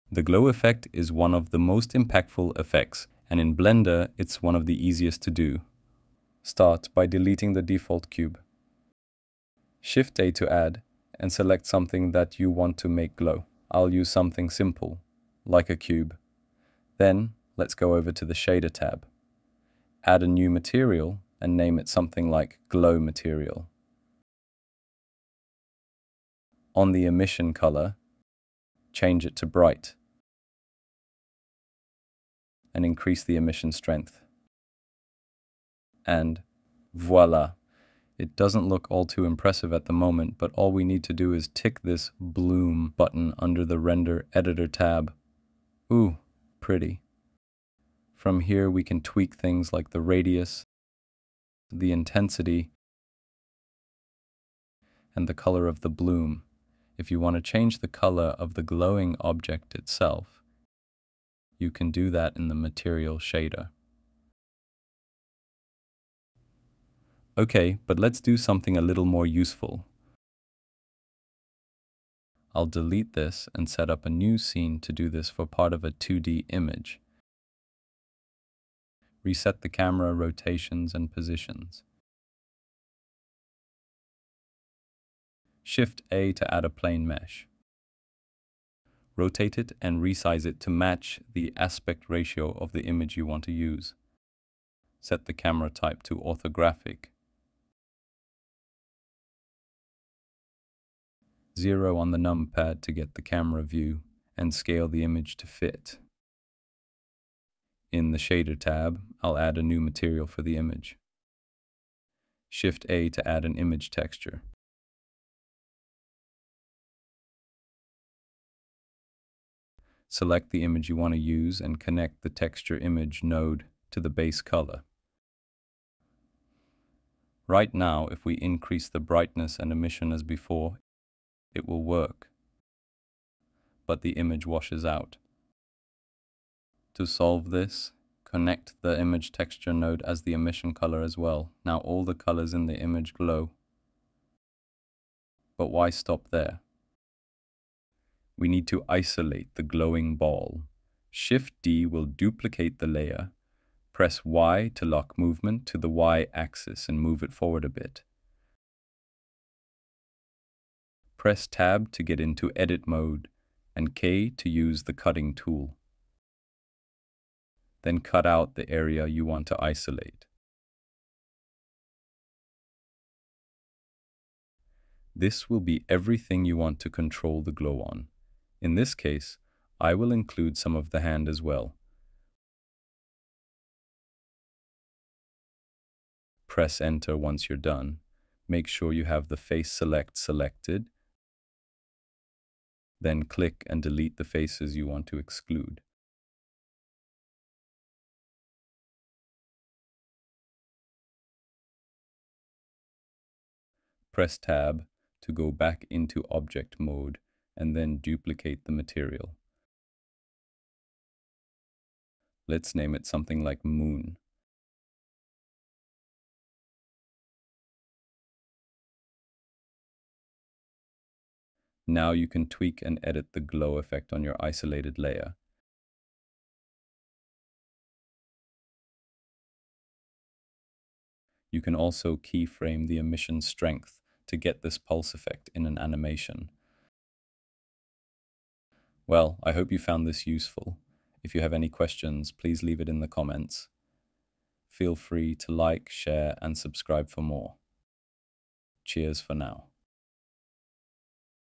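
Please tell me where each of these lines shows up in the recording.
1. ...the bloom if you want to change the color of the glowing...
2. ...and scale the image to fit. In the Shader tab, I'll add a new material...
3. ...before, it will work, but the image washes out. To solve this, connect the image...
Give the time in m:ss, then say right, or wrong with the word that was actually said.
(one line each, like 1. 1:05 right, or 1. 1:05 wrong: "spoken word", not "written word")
1. 0:55 right
2. 1:44 right
3. 2:10 right.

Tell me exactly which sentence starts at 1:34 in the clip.
Set the camera type to orthographic.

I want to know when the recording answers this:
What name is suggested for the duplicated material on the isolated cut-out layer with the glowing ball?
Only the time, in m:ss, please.
3:33.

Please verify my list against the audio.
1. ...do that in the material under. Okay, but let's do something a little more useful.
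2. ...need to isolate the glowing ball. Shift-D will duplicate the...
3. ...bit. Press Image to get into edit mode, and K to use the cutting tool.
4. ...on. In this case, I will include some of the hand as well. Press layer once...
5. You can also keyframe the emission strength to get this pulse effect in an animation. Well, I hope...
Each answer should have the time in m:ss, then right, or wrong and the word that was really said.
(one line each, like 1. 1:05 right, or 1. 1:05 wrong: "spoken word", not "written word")
1. 1:01 wrong: "shader", not "under"
2. 2:28 right
3. 2:37 wrong: "Tab", not "Image"
4. 2:57 wrong: "enter", not "layer"
5. 3:51 right.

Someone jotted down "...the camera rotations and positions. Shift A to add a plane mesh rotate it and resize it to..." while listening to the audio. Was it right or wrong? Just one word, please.
right.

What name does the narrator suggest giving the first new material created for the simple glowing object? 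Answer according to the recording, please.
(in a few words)
Glow Material.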